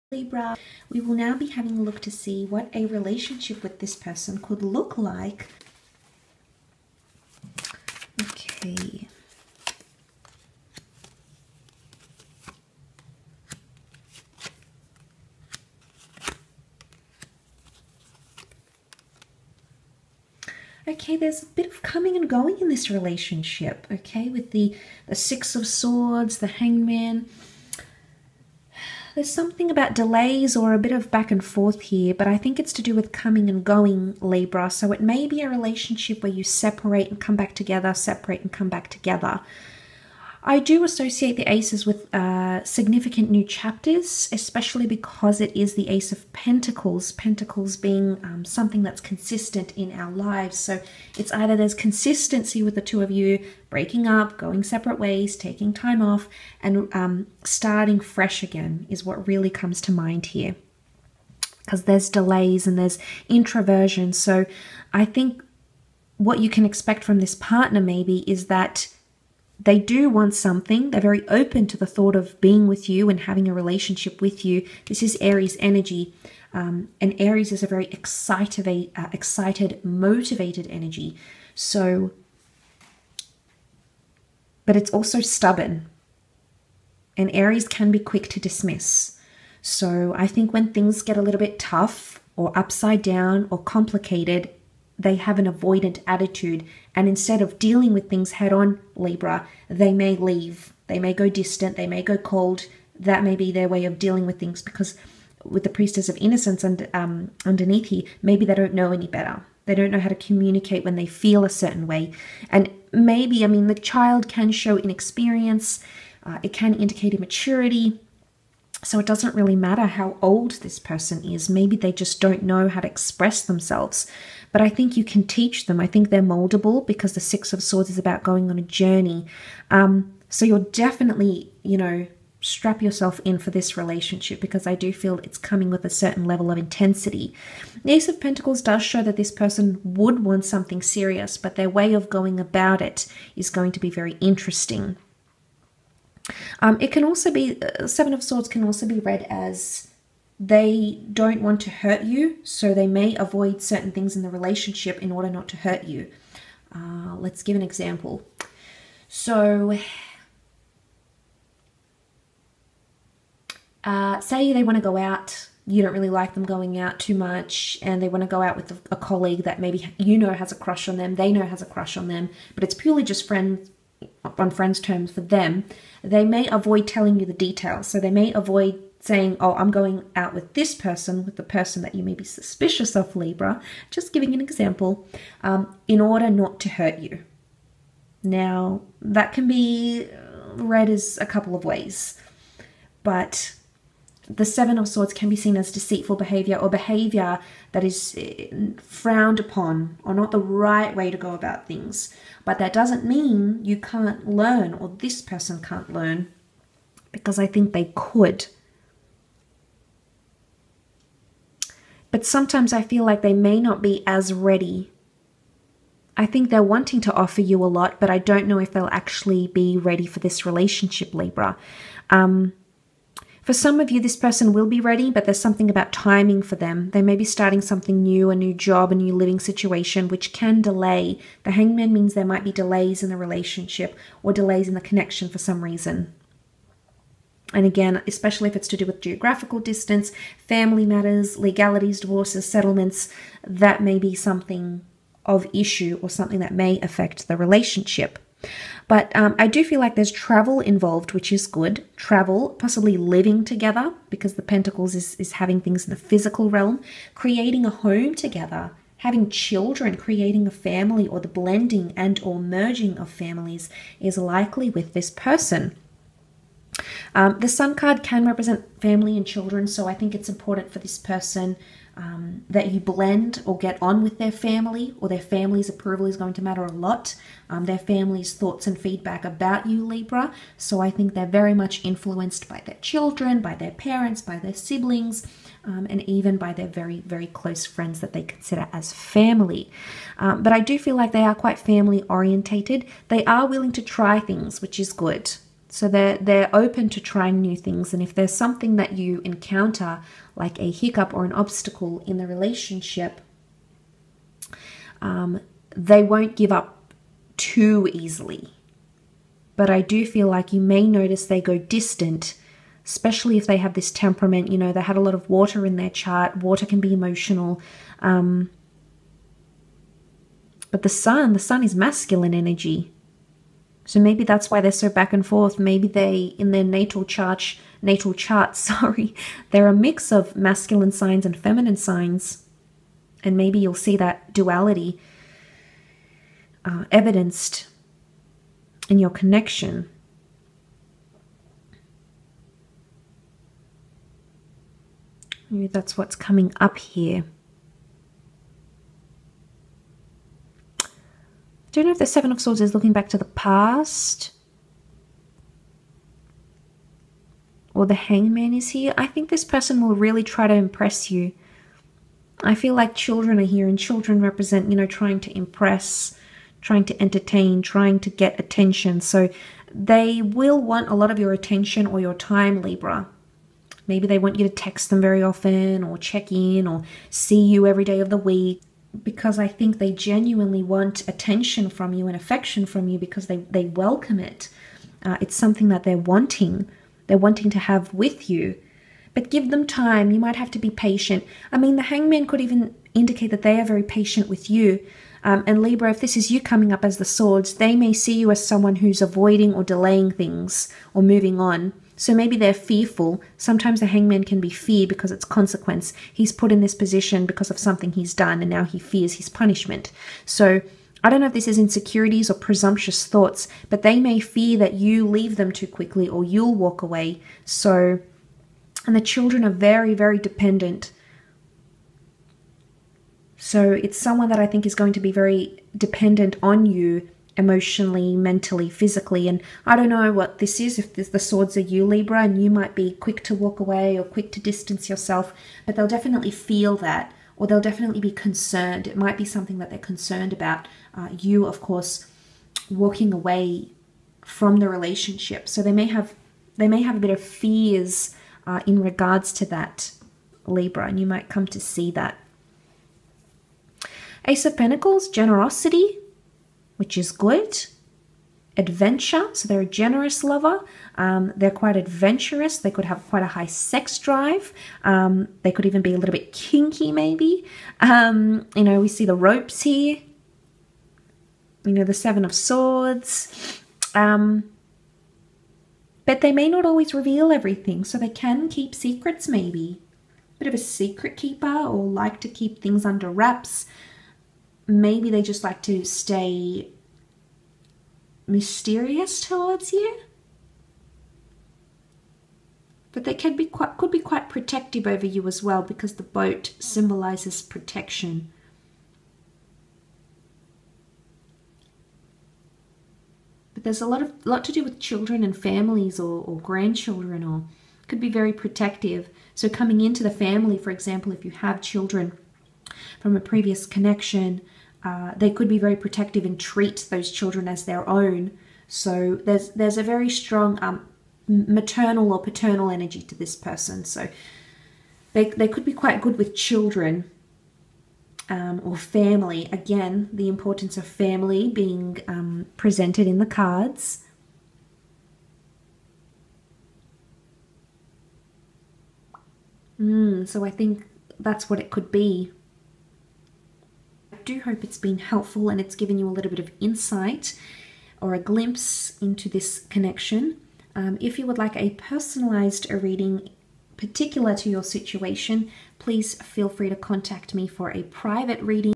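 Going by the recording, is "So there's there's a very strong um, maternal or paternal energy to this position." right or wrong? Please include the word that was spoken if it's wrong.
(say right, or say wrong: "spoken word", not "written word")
wrong: "person", not "position".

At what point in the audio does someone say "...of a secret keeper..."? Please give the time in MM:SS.
08:00.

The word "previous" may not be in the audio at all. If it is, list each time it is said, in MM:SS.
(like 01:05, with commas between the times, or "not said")
08:33.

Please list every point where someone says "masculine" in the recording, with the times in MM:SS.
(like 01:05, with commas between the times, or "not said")
05:21, 05:30.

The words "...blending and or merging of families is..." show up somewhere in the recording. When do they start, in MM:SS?
04:21.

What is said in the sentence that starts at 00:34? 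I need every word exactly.
So it may be a relationship where you separate and come back together, separate and come back together.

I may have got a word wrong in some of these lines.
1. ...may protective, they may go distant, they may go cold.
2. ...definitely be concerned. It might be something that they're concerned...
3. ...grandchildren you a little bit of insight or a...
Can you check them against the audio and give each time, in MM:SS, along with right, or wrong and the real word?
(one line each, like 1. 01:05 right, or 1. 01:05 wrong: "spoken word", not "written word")
1. 01:39 wrong: "leave", not "protective"
2. 07:17 right
3. 09:05 wrong: "given", not "grandchildren".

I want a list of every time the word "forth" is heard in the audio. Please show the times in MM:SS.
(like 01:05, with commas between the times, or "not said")
00:31, 05:25.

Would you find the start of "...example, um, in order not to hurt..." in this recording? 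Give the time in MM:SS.
03:04.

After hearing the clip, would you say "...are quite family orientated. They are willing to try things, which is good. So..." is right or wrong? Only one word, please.
right.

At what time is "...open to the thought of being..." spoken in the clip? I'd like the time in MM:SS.
01:11.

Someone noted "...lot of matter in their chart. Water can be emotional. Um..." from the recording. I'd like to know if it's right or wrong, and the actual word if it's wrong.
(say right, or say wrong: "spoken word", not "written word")
wrong: "water", not "matter".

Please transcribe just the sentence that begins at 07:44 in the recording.
Um, they could even be a little bit kinky, maybe.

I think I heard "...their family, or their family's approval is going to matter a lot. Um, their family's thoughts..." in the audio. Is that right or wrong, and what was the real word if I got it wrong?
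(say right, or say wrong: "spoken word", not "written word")
right.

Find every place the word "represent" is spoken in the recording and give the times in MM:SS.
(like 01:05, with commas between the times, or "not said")
04:28, 06:04.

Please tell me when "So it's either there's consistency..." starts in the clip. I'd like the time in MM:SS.
00:50.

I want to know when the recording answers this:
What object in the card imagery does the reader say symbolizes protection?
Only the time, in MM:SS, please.
08:15.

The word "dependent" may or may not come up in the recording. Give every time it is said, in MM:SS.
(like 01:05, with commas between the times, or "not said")
07:00, 07:05.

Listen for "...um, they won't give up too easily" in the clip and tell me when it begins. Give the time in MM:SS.
05:05.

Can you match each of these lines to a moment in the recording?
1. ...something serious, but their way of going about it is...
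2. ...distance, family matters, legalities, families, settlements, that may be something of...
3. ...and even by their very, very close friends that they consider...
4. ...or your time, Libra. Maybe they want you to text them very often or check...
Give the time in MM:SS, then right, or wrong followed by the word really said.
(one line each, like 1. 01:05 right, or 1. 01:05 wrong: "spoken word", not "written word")
1. 02:20 right
2. 03:59 wrong: "divorces", not "families"
3. 04:45 right
4. 06:11 right.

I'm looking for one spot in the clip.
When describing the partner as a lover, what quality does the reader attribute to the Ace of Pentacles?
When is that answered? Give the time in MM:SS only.
07:35.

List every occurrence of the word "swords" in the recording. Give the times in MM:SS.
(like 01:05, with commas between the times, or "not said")
00:25, 02:07, 02:28, 03:14, 05:52, 06:37, 07:11, 07:52.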